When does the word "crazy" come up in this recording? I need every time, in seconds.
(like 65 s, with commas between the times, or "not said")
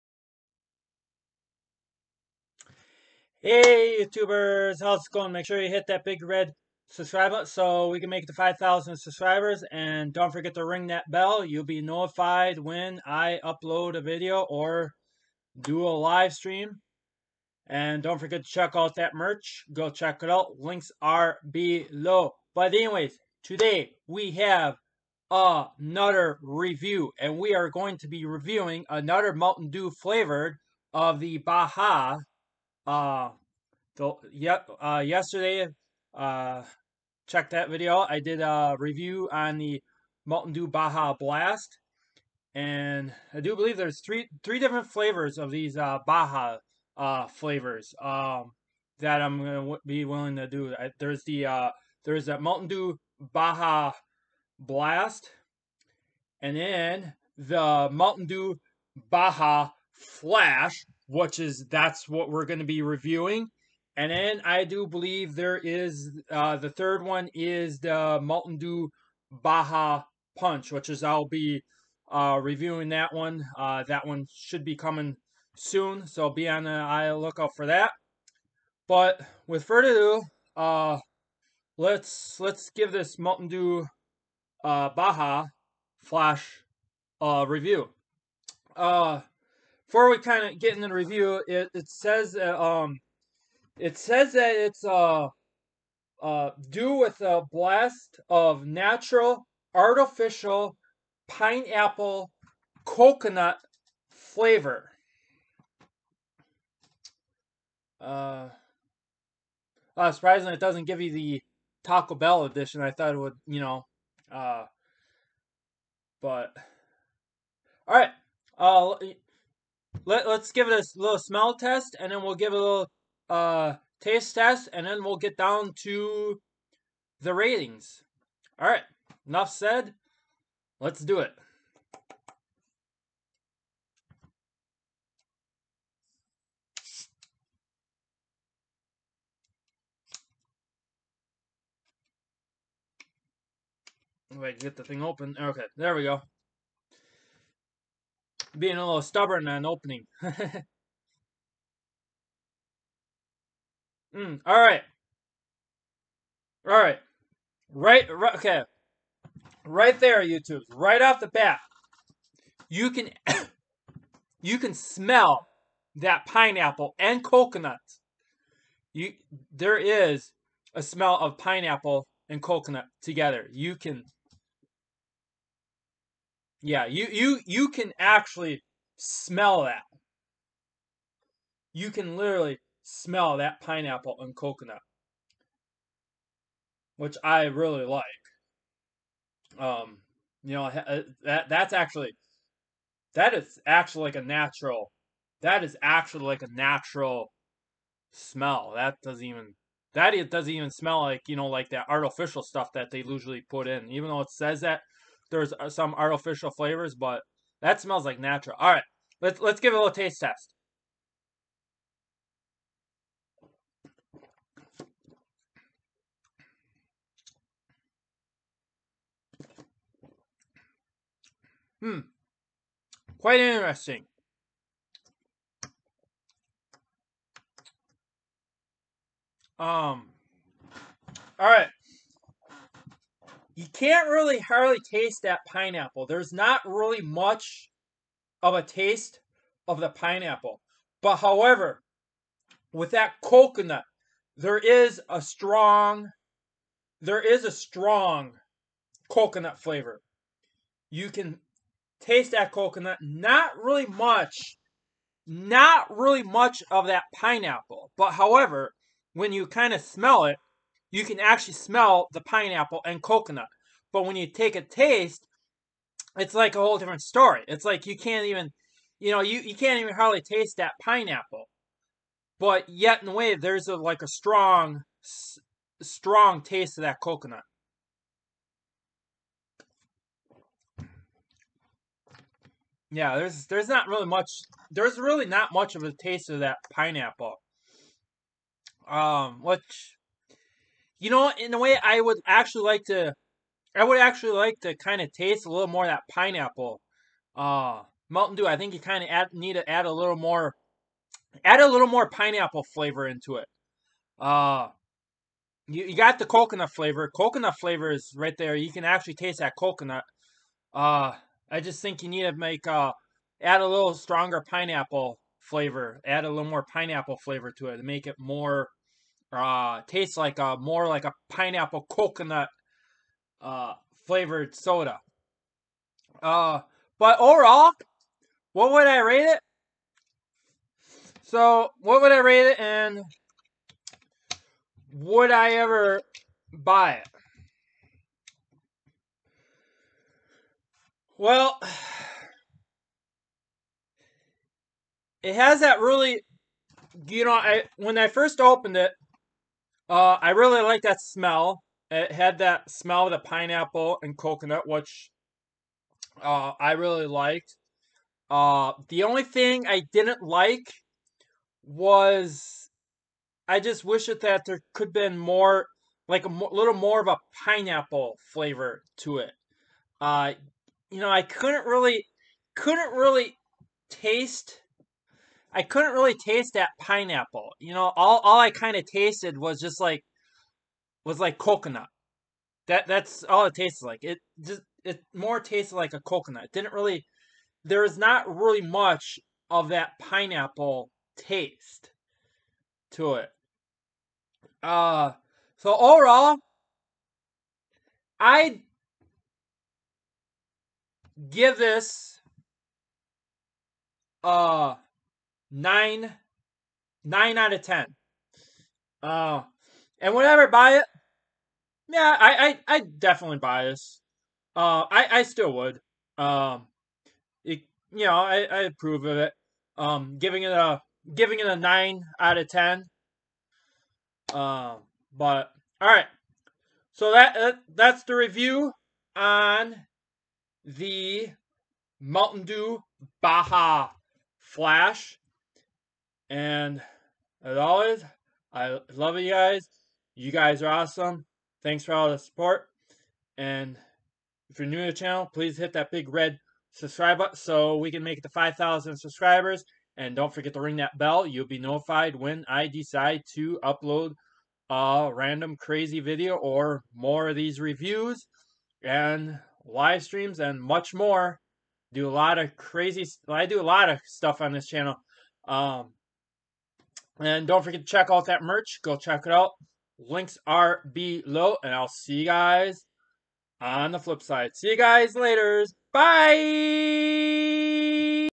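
455 s, 462 s.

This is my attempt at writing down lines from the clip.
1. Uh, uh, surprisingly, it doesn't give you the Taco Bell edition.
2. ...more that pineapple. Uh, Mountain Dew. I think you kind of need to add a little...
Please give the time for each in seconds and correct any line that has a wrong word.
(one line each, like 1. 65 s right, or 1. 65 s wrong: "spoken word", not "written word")
1. 107 s right
2. 295 s right.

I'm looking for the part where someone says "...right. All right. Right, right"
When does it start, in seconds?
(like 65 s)
154 s.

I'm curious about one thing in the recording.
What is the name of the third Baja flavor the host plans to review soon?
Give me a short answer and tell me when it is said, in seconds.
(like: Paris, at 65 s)
Mountain Dew Baja Punch, at 68 s.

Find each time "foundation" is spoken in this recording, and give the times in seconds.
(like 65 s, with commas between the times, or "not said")
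not said.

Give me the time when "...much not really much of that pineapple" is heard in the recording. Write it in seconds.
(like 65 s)
253 s.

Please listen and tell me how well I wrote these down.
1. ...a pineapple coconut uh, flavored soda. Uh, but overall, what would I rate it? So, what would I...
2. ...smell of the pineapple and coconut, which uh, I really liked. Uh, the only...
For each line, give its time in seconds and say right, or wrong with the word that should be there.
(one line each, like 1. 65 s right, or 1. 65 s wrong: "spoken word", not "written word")
1. 321 s right
2. 352 s right.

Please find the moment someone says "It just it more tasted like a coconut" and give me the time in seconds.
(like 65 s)
384 s.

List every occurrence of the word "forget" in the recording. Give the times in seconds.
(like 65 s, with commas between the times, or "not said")
10 s, 18 s, 450 s, 467 s.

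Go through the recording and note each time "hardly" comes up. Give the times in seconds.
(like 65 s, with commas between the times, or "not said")
234 s, 269 s.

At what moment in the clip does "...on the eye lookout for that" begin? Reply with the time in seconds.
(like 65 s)
76 s.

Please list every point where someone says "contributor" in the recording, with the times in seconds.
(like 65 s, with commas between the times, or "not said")
not said.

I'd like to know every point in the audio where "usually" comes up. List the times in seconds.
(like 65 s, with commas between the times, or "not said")
203 s.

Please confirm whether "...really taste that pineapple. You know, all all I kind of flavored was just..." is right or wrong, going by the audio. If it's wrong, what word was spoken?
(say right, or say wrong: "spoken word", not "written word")
wrong: "tasted", not "flavored".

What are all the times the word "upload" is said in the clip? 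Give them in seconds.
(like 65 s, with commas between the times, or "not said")
13 s, 453 s.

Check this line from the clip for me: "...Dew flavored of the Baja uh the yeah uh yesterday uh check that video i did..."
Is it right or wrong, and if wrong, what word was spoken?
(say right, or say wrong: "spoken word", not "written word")
right.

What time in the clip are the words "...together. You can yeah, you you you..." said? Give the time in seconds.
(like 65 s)
173 s.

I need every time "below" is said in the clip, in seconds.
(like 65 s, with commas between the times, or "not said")
21 s, 470 s.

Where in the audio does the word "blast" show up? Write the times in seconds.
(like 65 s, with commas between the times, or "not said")
41 s, 54 s, 97 s.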